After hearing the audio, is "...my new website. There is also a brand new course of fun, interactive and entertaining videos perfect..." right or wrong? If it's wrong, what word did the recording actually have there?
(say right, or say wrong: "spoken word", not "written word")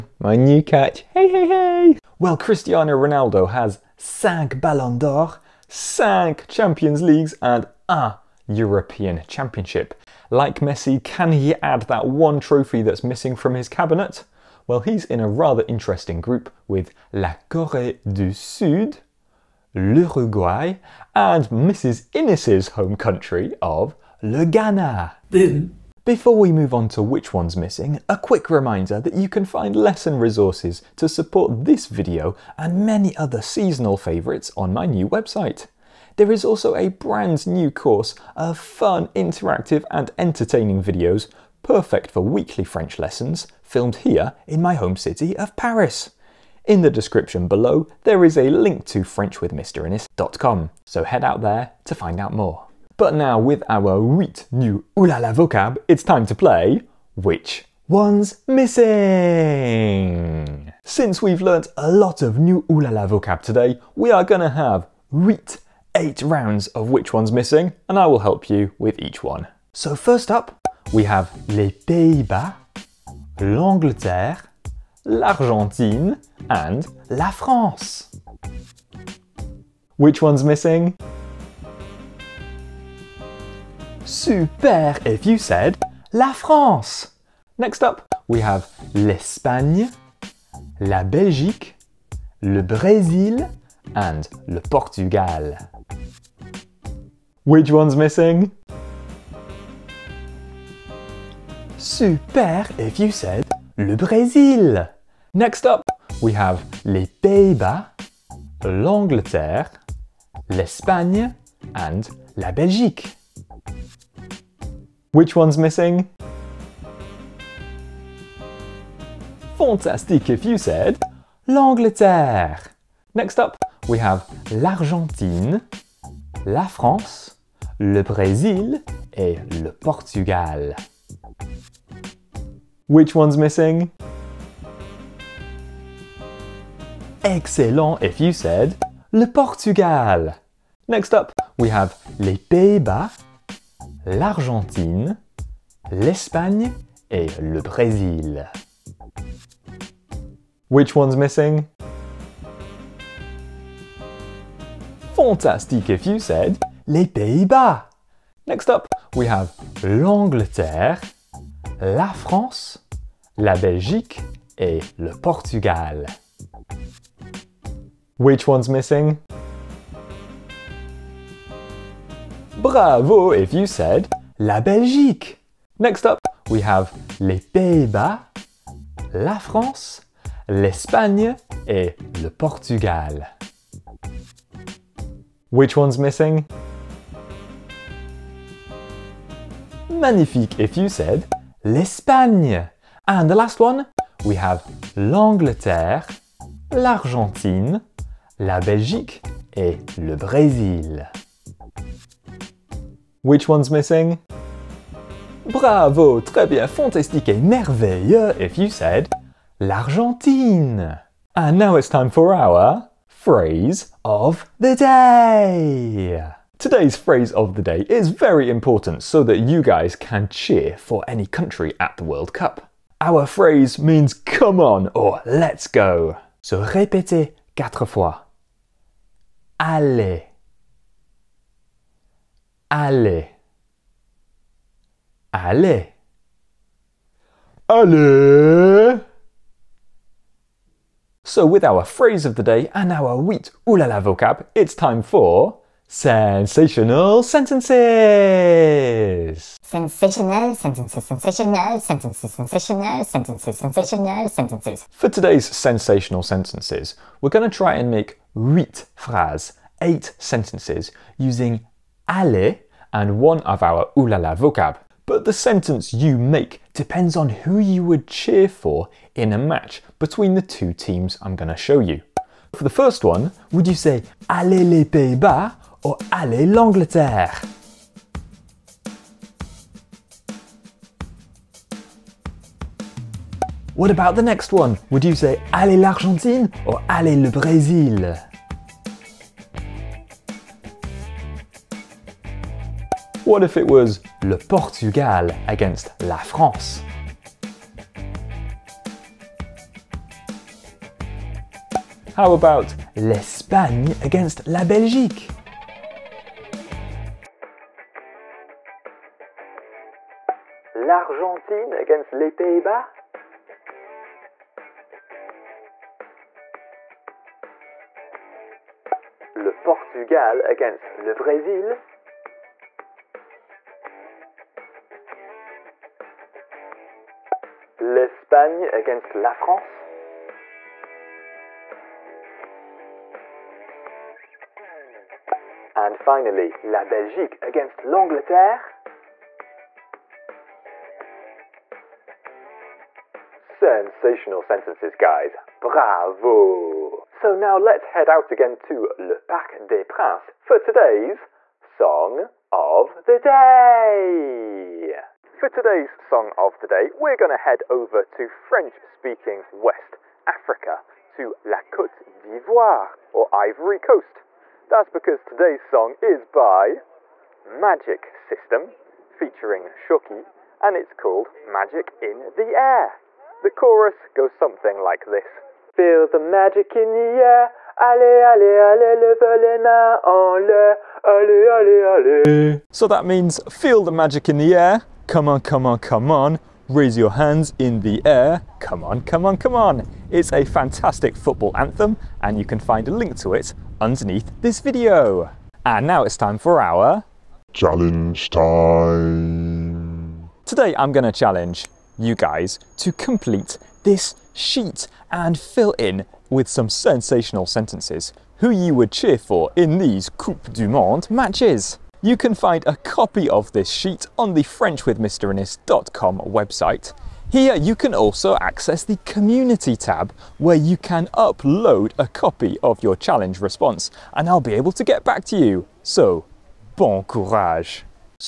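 right.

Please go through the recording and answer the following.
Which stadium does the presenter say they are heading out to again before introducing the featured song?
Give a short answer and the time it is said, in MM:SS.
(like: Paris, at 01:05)
Parc des Princes, at 05:49.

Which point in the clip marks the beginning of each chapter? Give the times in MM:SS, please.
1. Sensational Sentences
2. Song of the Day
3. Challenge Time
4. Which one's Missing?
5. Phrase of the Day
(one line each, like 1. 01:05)
1. 04:01
2. 05:47
3. 06:35
4. 00:25
5. 03:31.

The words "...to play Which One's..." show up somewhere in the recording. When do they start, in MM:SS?
00:56.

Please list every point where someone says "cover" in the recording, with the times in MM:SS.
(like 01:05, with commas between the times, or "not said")
not said.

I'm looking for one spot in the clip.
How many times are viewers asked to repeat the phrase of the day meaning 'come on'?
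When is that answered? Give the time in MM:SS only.
03:47.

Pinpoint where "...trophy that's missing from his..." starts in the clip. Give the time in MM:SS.
00:12.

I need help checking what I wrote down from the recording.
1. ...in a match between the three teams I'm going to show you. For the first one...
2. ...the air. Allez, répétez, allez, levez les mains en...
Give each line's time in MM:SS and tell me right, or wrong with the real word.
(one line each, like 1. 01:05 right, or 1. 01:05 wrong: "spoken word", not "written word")
1. 04:29 wrong: "two", not "three"
2. 06:16 wrong: "allez", not "répétez".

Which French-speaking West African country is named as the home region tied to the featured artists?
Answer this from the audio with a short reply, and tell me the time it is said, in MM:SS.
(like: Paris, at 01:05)
Côte d'Ivoire, at 06:01.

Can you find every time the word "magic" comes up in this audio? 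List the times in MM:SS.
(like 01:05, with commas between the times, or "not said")
06:07, 06:11, 06:16, 06:23.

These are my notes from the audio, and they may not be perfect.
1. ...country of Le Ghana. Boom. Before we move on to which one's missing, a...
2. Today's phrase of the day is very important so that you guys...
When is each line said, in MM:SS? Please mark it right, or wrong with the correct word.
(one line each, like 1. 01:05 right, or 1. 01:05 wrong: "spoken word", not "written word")
1. 00:22 right
2. 03:36 right.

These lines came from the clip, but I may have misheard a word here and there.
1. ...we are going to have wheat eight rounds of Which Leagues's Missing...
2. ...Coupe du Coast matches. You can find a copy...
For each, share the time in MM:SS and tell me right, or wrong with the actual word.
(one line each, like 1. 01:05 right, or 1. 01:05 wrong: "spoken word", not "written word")
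1. 01:03 wrong: "One", not "Leagues"
2. 06:50 wrong: "Monde", not "Coast".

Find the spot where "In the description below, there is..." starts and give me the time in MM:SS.
00:46.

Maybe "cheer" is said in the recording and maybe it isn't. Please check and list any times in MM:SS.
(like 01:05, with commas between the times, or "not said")
03:40, 04:28, 06:48.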